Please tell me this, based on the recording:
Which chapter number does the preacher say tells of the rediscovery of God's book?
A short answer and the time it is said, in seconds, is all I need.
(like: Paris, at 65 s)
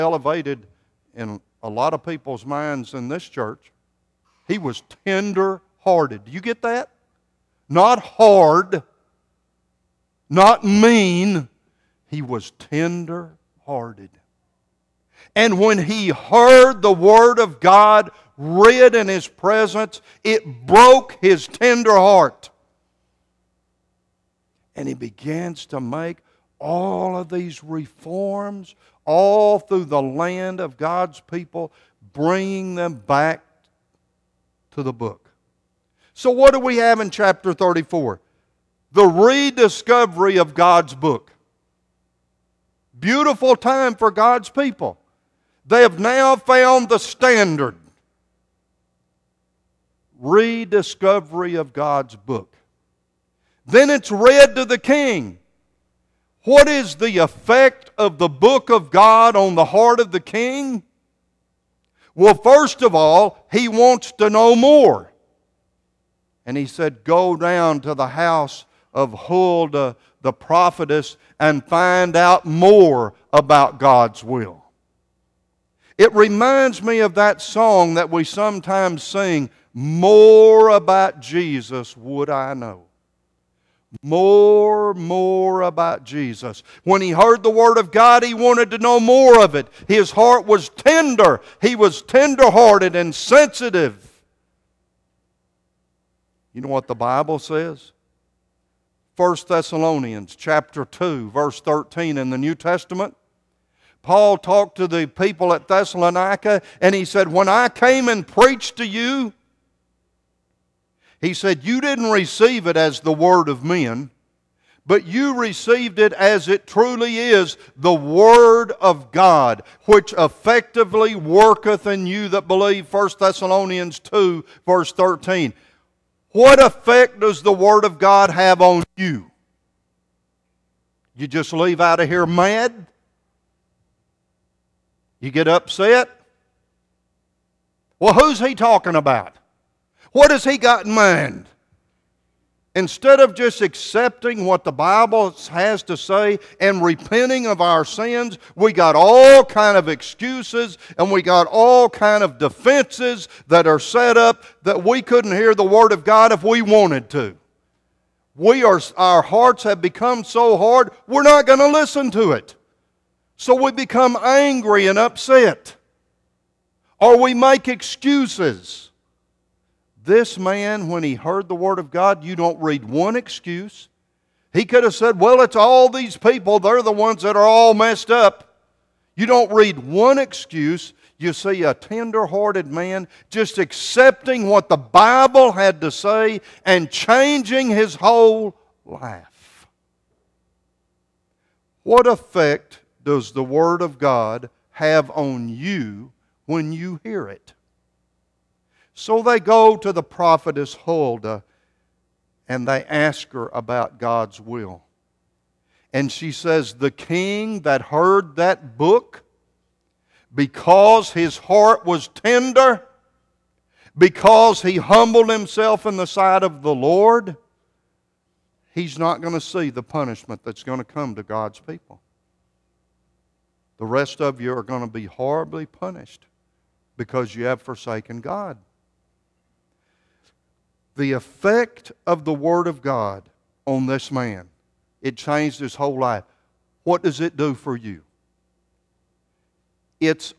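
34, at 37 s.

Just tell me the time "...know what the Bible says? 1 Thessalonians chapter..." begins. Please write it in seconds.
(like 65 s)
96 s.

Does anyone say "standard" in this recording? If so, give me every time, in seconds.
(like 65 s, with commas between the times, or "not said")
46 s.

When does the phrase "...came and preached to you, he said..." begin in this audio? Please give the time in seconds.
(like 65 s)
107 s.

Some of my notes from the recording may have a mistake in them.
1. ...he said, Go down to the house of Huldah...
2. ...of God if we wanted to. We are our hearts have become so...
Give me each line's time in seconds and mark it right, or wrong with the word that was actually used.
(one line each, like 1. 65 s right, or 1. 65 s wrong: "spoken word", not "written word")
1. 66 s right
2. 155 s right.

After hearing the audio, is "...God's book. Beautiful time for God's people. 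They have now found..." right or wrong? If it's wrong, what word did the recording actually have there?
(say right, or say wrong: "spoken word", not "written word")
right.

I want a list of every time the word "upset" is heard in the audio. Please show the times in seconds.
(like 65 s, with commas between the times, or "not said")
135 s, 164 s.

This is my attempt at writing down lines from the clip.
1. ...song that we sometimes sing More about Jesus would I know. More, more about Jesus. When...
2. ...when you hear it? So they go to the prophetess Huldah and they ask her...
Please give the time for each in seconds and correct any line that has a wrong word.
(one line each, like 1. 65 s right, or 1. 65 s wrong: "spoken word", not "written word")
1. 77 s right
2. 196 s right.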